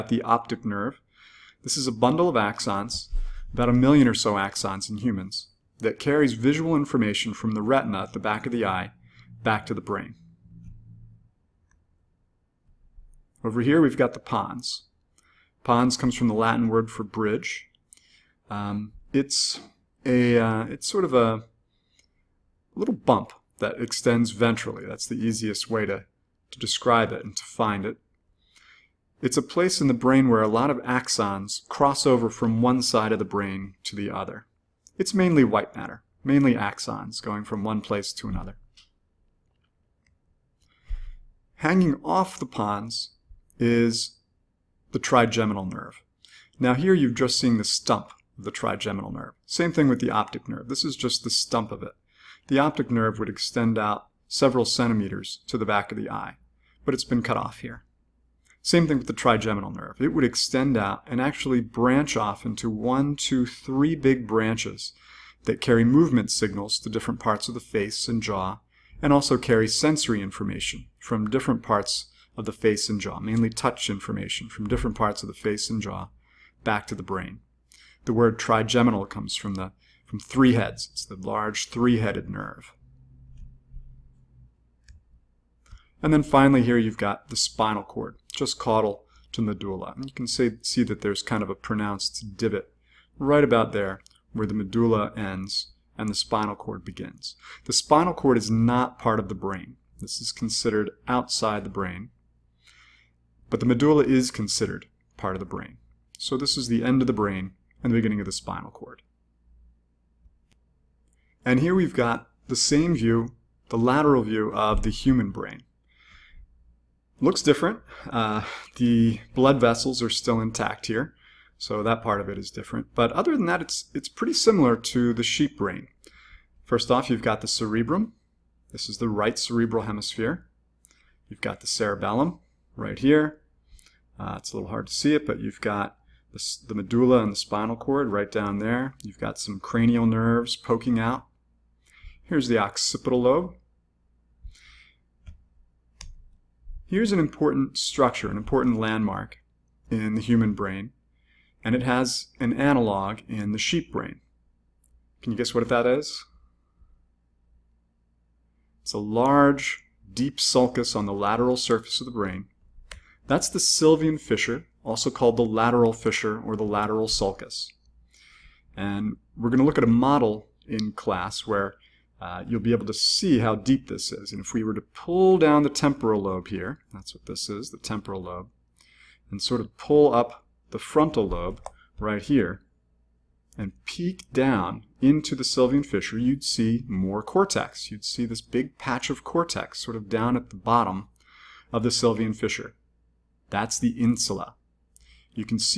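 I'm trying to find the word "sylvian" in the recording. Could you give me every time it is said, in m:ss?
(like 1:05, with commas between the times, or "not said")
2:43, 3:05, 3:11.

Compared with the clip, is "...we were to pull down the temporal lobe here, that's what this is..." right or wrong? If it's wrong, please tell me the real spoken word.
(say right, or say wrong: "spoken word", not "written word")
right.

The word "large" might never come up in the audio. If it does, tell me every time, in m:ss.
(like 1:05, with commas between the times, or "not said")
1:21, 2:38.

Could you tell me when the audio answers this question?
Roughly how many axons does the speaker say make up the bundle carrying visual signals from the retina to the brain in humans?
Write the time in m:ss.
0:03.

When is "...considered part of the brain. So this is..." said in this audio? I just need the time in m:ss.
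1:44.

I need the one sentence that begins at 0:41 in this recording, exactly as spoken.
Hanging off the pons is the trigeminal nerve.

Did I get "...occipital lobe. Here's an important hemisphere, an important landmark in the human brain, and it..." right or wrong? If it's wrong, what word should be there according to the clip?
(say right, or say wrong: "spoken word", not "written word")
wrong: "structure", not "hemisphere".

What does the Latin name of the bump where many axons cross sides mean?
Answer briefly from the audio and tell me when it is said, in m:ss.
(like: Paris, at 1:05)
bridge, at 0:17.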